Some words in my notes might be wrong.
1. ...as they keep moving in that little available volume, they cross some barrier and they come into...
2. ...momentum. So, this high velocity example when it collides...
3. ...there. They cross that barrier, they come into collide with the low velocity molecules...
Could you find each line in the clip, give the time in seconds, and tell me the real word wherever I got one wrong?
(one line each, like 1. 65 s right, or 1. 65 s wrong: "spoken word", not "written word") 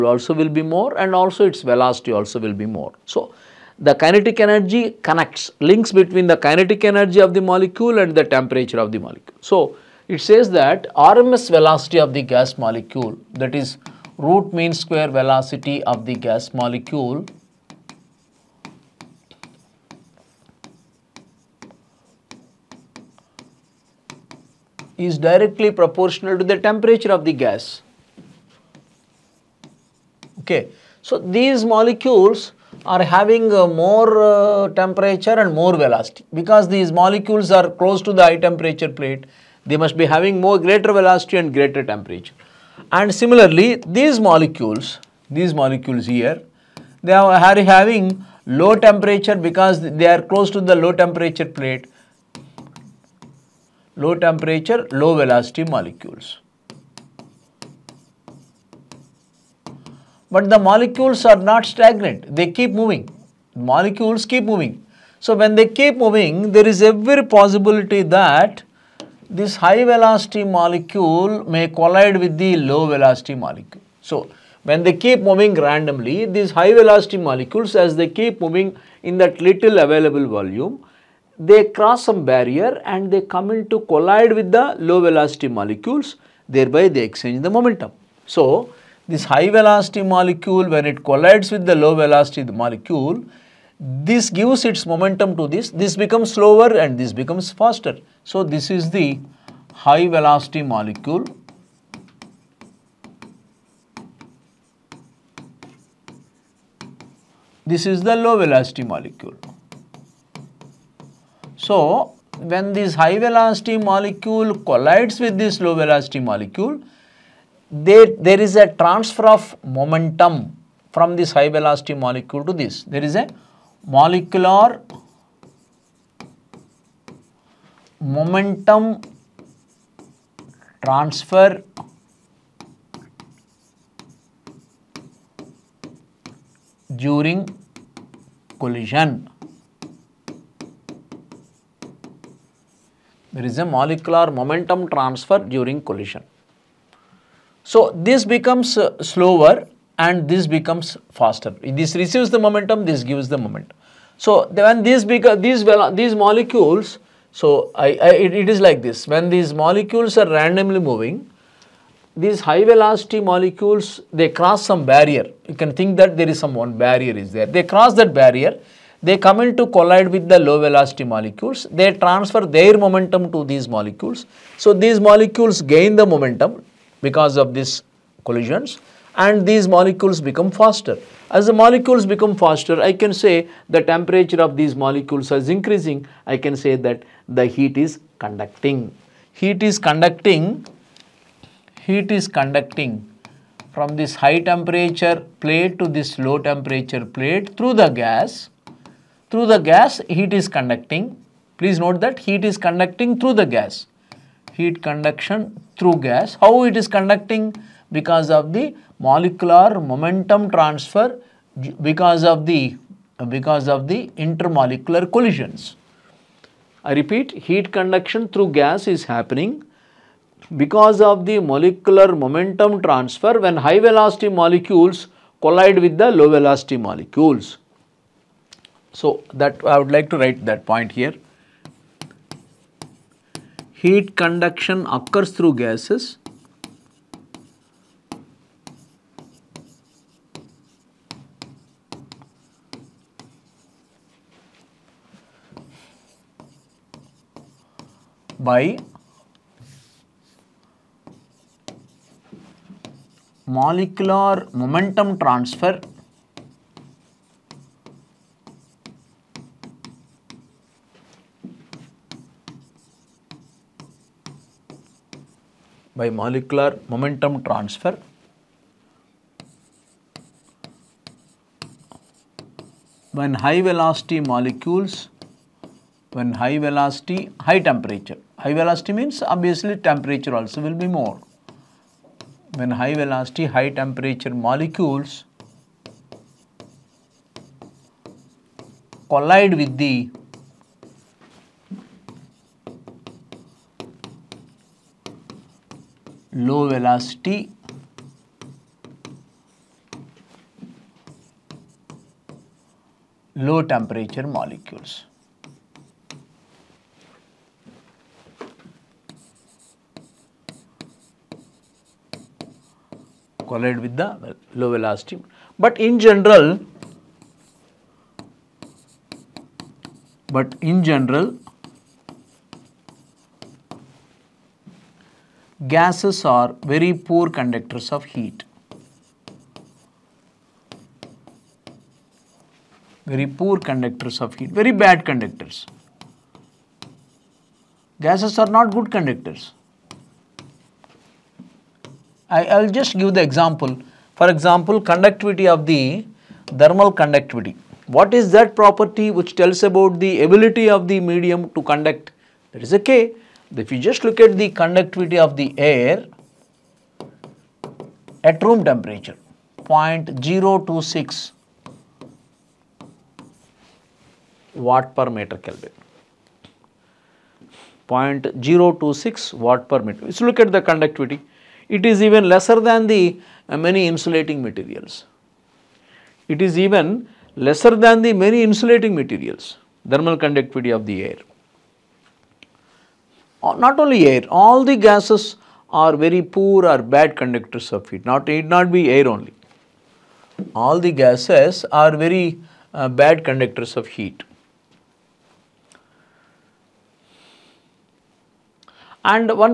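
1. 77 s right
2. 87 s wrong: "molecule", not "example"
3. 167 s right.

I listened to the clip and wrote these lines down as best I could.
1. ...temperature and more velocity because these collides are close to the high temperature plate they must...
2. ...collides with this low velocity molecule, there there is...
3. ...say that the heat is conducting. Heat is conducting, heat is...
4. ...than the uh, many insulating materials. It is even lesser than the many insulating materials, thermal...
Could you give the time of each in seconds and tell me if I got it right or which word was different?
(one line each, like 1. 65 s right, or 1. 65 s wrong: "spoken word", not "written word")
1. 34 s wrong: "molecules", not "collides"
2. 114 s right
3. 186 s right
4. 372 s right.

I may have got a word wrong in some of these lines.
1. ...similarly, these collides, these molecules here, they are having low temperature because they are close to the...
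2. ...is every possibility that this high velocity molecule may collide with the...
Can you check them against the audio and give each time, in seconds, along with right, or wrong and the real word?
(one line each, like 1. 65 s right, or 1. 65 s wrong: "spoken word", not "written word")
1. 43 s wrong: "molecules", not "collides"
2. 66 s right.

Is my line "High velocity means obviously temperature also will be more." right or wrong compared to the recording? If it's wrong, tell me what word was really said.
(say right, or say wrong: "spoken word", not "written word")
right.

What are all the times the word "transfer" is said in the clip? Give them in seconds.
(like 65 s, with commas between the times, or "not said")
118 s, 130 s, 144 s, 171 s, 210 s, 222 s, 255 s, 267 s.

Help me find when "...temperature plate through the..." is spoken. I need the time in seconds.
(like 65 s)
196 s.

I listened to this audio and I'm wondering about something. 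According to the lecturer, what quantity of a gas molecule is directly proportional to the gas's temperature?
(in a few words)
RMS velocity.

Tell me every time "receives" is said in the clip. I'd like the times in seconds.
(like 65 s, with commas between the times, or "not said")
152 s.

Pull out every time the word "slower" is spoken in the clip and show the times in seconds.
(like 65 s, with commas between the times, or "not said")
96 s, 149 s.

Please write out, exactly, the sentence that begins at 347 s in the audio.
What is that property which tells about the ability of the medium to conduct?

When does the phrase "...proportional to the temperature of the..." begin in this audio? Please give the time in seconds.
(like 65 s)
25 s.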